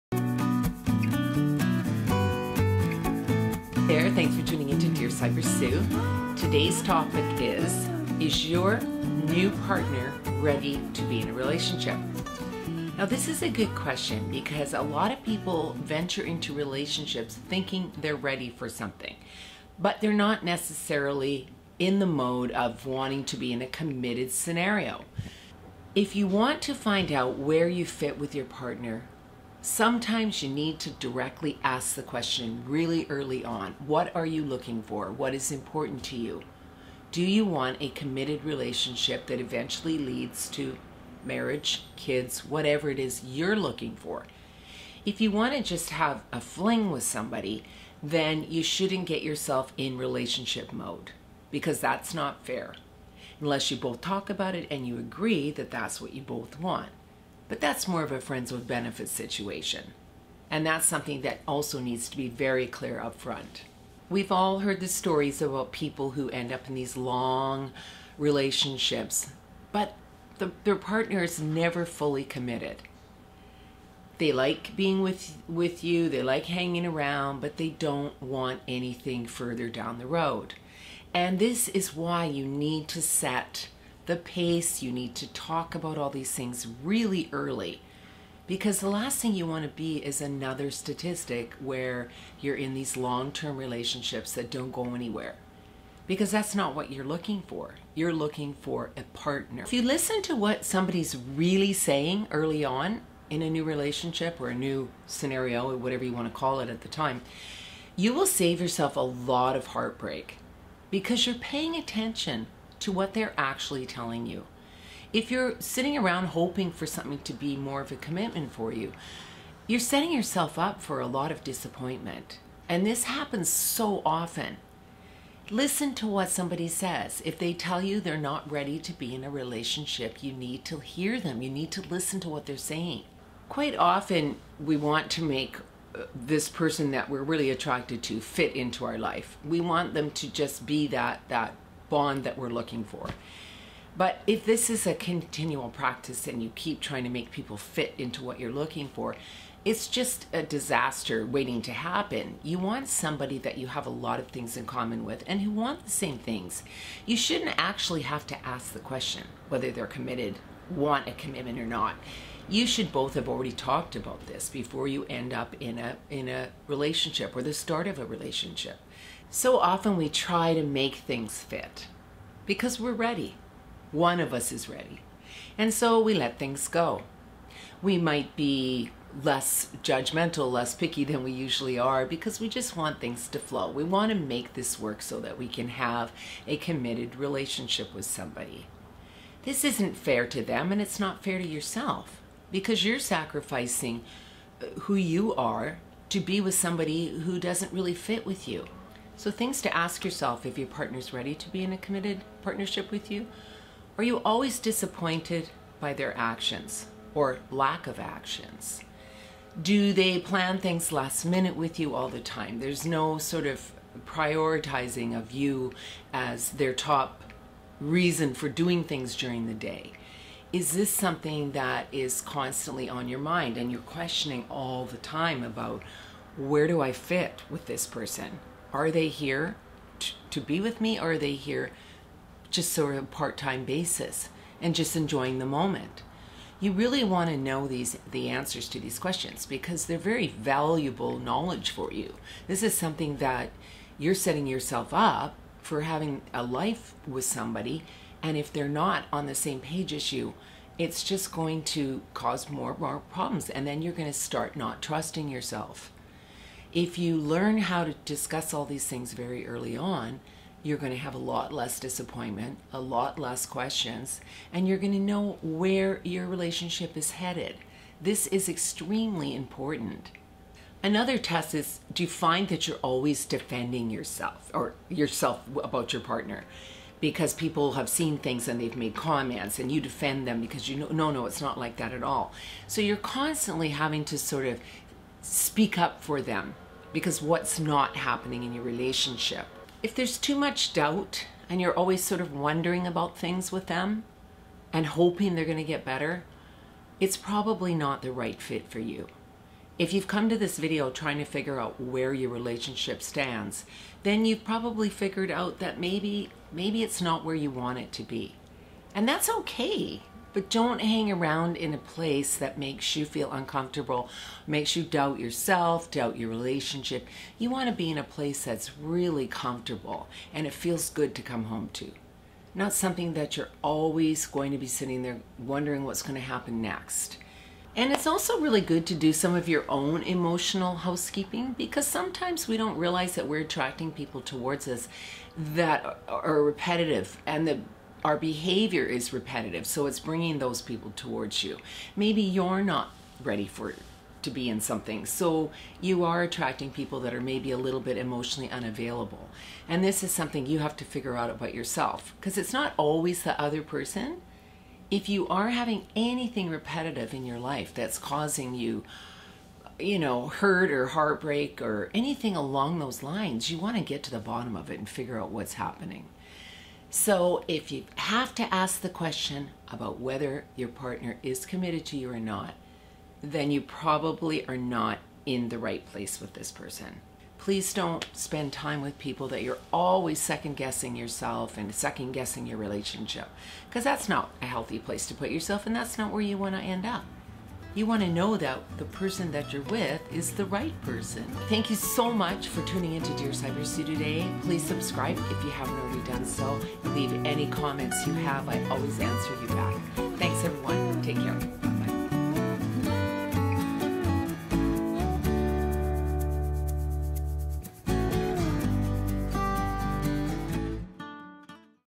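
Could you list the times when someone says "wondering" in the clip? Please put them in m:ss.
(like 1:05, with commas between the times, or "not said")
4:52, 5:25.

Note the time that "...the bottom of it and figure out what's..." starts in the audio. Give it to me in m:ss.
6:04.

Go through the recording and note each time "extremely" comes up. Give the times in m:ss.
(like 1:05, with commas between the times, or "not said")
4:28.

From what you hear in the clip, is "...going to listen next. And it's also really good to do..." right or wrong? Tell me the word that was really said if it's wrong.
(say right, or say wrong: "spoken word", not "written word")
wrong: "happen", not "listen".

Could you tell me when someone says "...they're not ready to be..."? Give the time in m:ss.
2:07.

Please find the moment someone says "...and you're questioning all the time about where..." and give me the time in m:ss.
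3:43.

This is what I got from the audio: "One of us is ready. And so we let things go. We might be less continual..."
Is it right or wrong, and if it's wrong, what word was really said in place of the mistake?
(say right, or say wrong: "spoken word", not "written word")
wrong: "judgmental", not "continual".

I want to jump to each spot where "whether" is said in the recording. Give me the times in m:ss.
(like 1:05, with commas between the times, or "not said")
2:39, 6:09.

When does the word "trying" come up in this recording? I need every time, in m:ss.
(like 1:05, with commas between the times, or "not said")
2:26, 5:00.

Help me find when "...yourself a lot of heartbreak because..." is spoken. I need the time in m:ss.
1:48.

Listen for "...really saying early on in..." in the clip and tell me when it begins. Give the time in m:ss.
1:41.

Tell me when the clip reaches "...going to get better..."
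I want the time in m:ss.
4:55.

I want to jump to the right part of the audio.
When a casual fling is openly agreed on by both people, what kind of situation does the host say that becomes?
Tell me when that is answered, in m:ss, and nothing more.
0:58.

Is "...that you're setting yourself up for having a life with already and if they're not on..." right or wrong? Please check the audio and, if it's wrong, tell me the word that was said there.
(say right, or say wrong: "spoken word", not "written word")
wrong: "somebody", not "already".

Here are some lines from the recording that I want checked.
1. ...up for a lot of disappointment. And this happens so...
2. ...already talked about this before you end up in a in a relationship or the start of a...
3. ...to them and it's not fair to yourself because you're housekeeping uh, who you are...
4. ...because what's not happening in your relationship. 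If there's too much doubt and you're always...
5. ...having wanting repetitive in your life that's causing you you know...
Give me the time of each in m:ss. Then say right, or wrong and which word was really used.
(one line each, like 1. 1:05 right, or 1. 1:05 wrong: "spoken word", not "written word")
1. 2:00 right
2. 2:43 right
3. 3:10 wrong: "sacrificing", not "housekeeping"
4. 4:46 right
5. 5:55 wrong: "anything", not "wanting".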